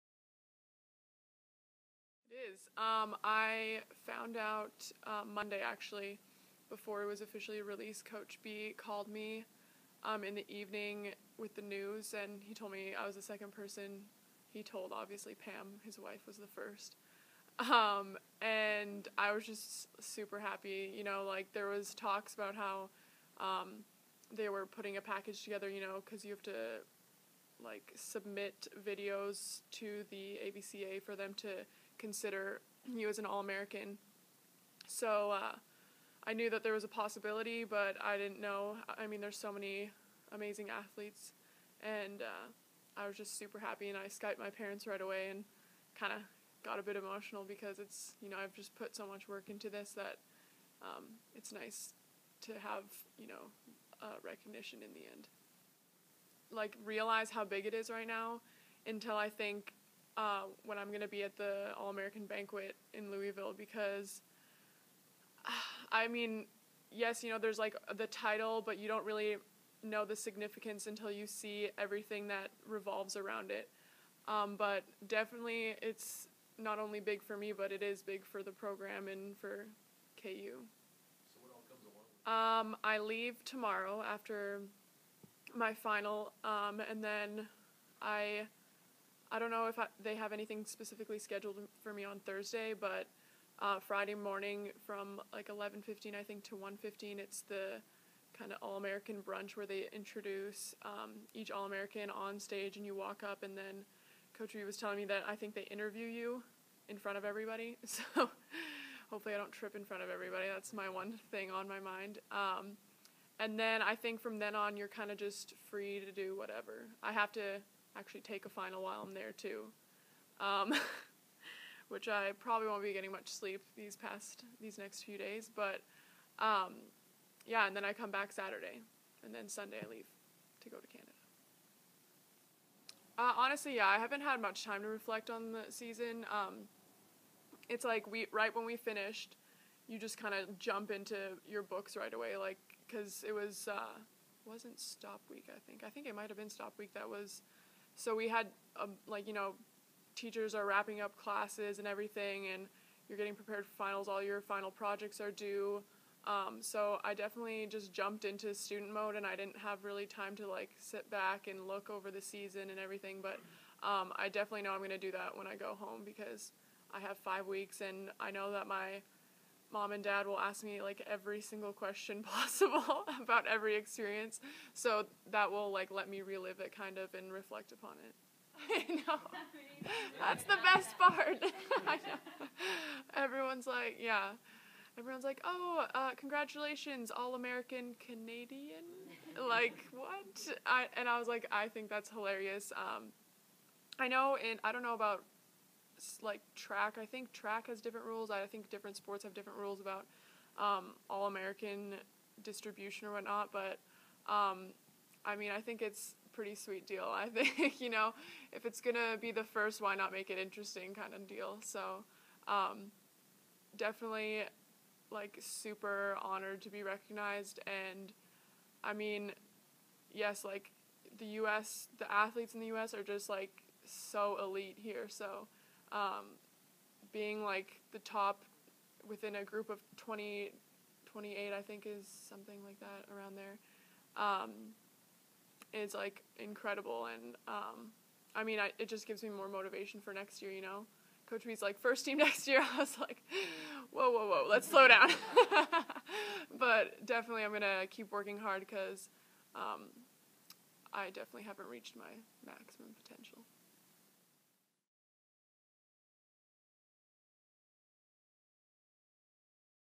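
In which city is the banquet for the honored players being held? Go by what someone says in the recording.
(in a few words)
Louisville.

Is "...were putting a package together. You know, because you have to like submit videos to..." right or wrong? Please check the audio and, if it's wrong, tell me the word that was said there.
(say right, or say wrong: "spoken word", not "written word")
right.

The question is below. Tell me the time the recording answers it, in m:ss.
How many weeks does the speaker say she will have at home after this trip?
2:47.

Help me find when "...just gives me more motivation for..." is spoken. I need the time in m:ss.
3:58.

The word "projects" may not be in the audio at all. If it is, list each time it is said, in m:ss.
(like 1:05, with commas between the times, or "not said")
2:34.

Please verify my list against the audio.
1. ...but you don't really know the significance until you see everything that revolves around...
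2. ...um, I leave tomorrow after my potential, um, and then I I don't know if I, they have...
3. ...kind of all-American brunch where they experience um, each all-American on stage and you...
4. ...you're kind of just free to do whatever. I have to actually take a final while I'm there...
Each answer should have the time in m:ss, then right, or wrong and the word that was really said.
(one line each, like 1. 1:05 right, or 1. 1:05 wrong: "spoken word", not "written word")
1. 1:08 right
2. 1:22 wrong: "final", not "potential"
3. 1:38 wrong: "introduce", not "experience"
4. 1:54 right.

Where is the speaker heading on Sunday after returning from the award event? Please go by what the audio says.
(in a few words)
Canada.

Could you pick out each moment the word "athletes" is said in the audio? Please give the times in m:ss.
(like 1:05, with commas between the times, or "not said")
0:40, 3:42.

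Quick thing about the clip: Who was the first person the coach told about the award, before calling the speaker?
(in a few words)
Pam.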